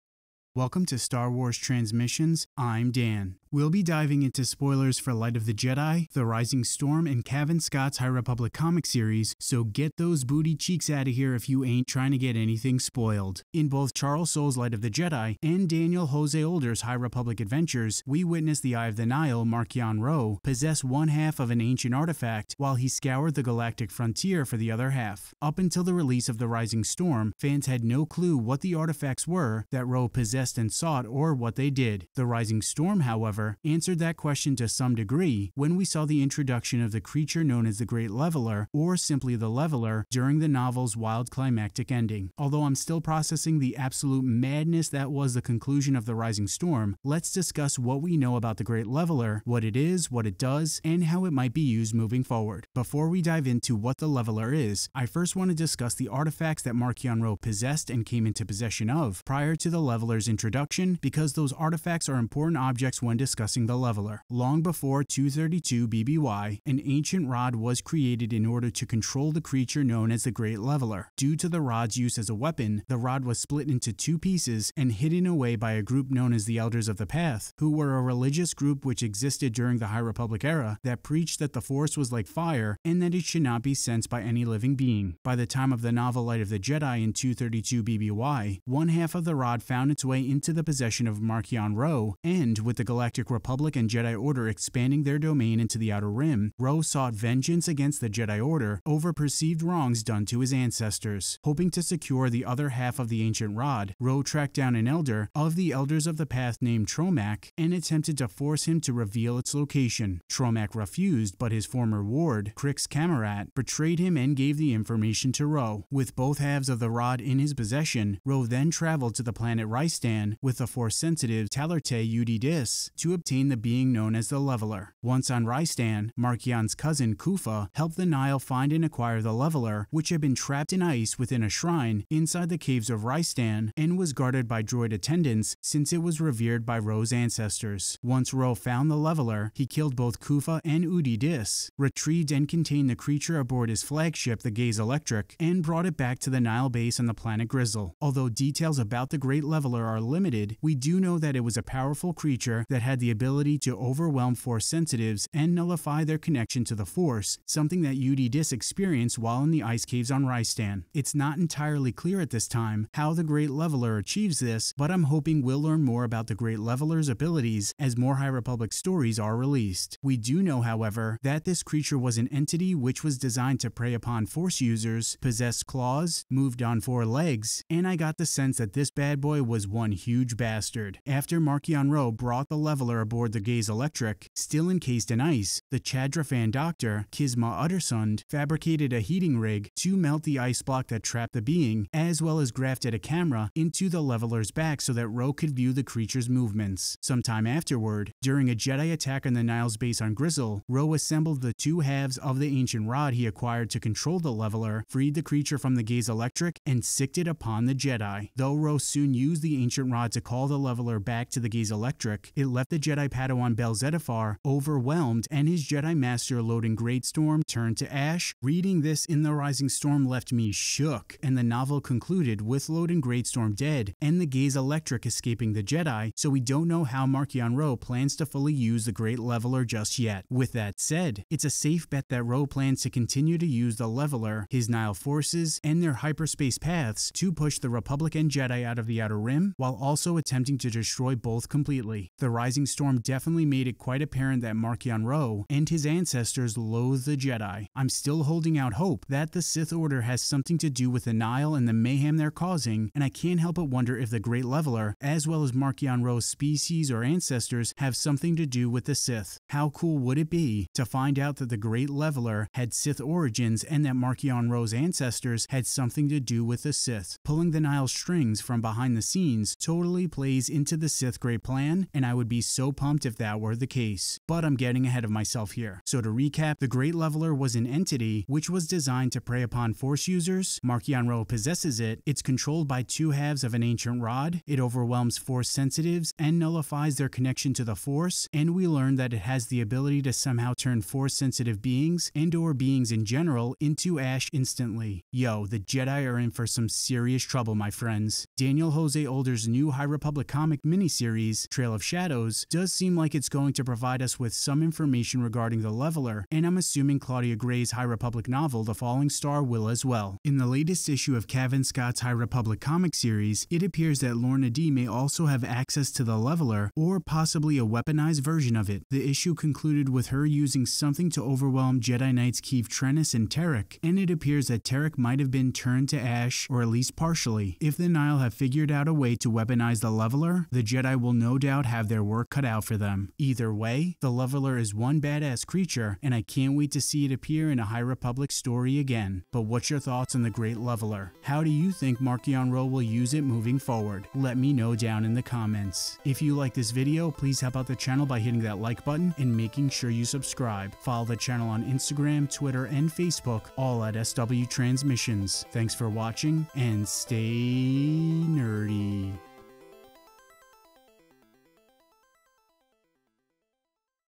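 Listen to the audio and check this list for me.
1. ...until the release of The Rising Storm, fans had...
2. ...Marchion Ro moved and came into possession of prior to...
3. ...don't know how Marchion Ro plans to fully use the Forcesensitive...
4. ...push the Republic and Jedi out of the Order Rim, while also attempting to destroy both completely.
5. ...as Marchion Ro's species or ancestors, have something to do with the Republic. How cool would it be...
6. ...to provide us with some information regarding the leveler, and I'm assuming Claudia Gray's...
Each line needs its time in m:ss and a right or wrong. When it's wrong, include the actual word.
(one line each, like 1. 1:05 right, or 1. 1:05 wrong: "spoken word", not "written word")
1. 0:25 right
2. 0:56 wrong: "possessed", not "moved"
3. 3:46 wrong: "Great", not "Forcesensitive"
4. 3:57 wrong: "Outer", not "Order"
5. 4:15 wrong: "Sith", not "Republic"
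6. 5:03 right.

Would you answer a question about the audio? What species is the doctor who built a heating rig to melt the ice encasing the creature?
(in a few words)
Chadrafan.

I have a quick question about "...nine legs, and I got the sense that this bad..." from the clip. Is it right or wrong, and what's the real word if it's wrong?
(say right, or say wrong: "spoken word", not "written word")
wrong: "four", not "nine".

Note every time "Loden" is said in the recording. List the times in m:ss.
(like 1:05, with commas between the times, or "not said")
3:36, 3:42.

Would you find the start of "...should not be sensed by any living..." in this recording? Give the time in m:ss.
1:23.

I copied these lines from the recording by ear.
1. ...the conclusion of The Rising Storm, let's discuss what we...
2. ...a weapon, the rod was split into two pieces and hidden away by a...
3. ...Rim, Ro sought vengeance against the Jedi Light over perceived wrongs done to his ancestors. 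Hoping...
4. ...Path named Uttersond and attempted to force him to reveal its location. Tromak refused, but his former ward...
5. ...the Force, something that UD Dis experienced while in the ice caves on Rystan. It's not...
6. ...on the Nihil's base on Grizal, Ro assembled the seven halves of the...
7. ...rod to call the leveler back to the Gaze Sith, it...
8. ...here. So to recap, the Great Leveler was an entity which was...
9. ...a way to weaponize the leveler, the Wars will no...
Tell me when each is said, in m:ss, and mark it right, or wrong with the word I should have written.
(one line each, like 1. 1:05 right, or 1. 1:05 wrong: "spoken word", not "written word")
1. 0:45 right
2. 1:12 right
3. 1:36 wrong: "Order", not "Light"
4. 1:46 wrong: "Tromak", not "Uttersond"
5. 2:36 right
6. 3:19 wrong: "two", not "seven"
7. 3:29 wrong: "Electric", not "Sith"
8. 4:35 right
9. 5:28 wrong: "Jedi", not "Wars".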